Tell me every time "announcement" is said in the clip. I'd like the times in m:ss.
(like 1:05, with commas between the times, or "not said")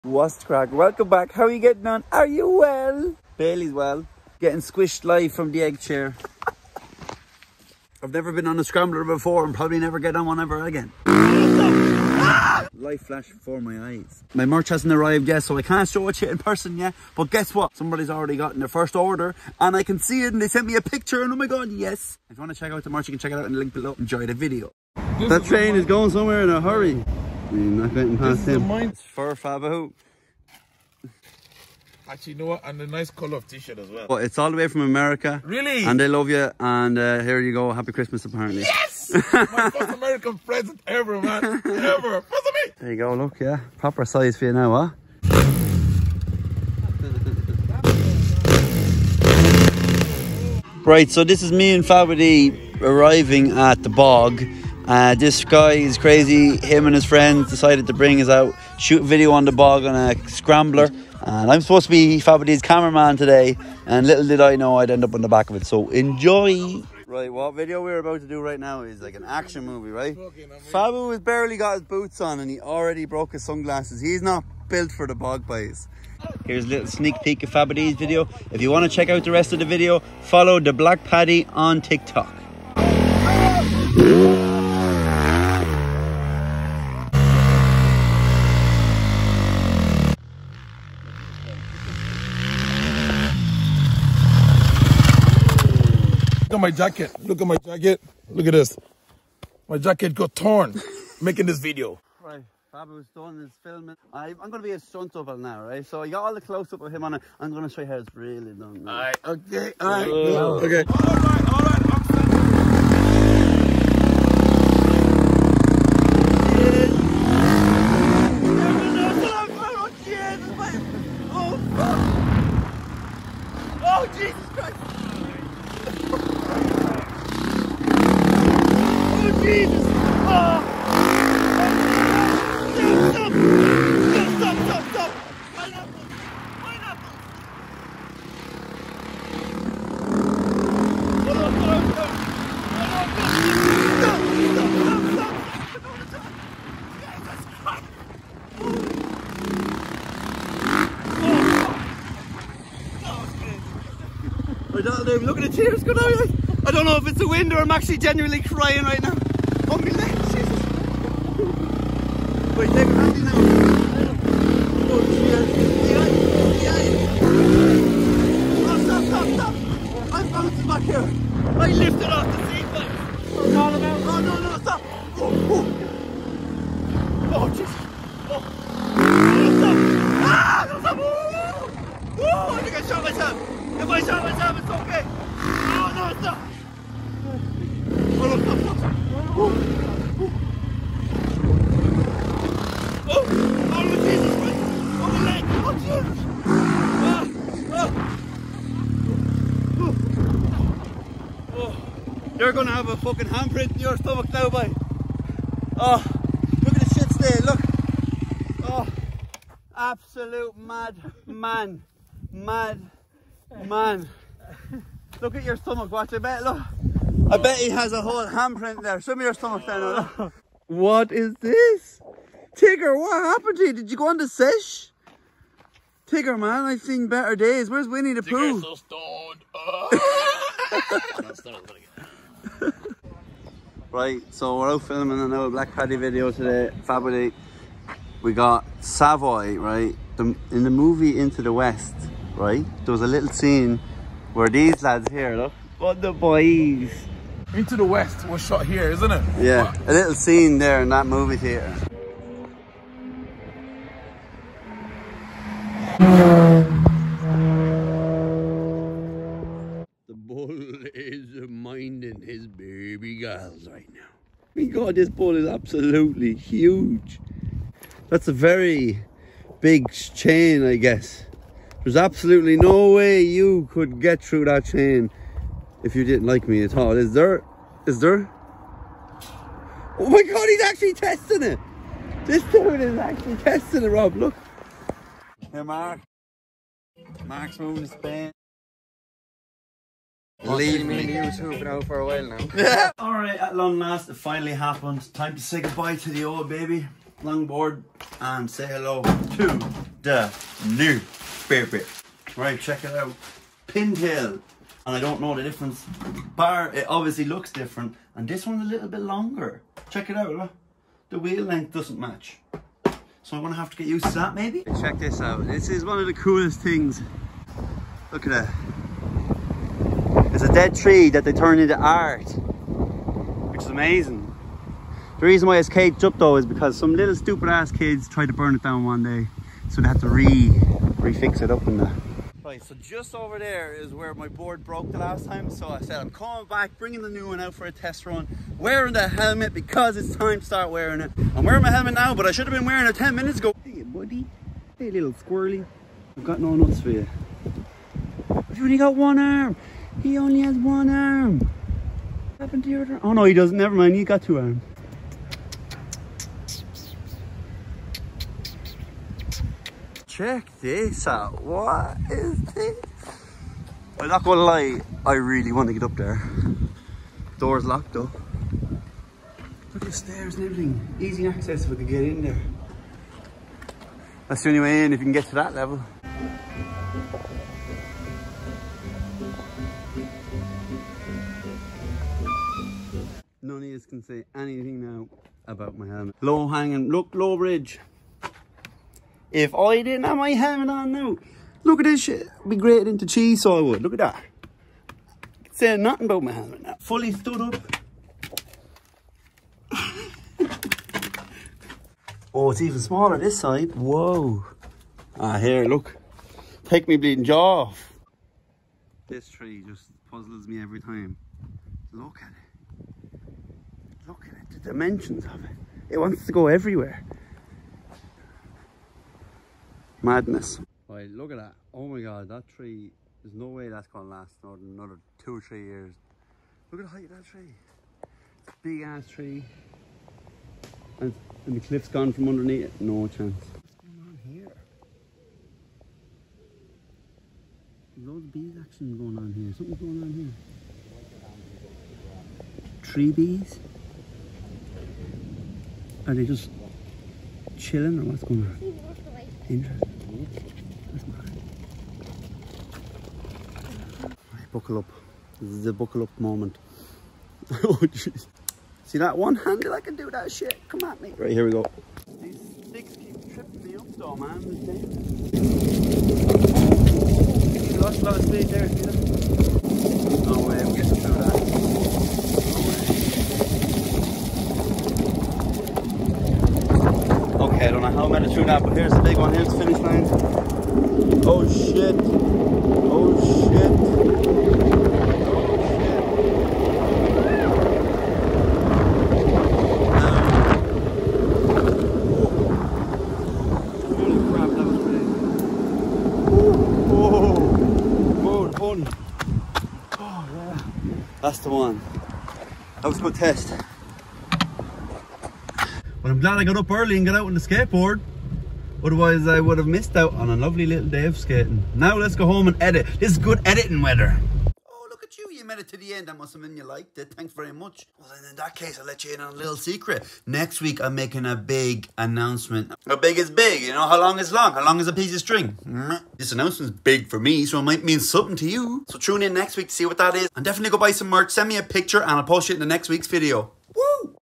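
8:41, 8:46.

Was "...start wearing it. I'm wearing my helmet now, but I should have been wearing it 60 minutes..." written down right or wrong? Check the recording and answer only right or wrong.
wrong.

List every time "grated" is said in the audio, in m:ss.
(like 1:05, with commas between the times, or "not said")
6:32.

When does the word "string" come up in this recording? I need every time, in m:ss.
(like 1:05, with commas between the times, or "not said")
8:45.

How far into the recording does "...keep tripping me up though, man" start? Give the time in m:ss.
7:42.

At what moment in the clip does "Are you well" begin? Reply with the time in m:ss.
0:02.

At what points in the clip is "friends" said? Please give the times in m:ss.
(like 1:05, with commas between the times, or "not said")
0:57.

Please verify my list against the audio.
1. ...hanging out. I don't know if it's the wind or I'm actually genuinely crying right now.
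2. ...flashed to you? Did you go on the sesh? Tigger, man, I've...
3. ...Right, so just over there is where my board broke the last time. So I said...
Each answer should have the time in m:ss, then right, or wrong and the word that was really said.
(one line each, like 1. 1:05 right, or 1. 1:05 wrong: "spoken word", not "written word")
1. 2:35 wrong: "coming", not "hanging"
2. 3:43 wrong: "happened", not "flashed"
3. 5:32 right.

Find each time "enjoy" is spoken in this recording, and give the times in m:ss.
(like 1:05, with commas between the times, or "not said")
0:23, 1:05.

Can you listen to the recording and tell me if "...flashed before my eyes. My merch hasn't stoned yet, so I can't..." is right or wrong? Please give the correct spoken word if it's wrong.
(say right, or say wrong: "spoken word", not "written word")
wrong: "arrived", not "stoned".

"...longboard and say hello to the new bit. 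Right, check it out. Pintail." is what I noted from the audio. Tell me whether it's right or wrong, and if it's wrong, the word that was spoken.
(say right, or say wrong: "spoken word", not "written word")
right.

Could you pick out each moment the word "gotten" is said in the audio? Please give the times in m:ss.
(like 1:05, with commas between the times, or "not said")
0:18, 0:27.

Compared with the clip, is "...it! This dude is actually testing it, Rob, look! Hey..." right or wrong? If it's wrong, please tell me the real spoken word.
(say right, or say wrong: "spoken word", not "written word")
right.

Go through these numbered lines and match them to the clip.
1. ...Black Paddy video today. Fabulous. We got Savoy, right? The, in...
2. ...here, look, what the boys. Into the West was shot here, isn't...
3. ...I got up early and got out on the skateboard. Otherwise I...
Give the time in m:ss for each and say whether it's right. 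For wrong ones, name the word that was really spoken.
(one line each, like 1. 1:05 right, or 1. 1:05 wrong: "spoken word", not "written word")
1. 3:55 right
2. 4:05 right
3. 8:26 right.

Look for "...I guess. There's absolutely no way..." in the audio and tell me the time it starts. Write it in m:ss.
4:30.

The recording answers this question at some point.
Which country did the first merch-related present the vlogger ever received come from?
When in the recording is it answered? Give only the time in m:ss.
0:34.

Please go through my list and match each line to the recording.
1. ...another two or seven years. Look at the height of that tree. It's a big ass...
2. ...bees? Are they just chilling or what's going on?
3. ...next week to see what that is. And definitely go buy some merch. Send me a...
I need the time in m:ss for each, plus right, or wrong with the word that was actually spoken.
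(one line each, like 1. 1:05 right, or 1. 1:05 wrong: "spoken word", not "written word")
1. 7:04 wrong: "three", not "seven"
2. 7:23 right
3. 8:49 right.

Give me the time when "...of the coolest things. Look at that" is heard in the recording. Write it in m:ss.
5:15.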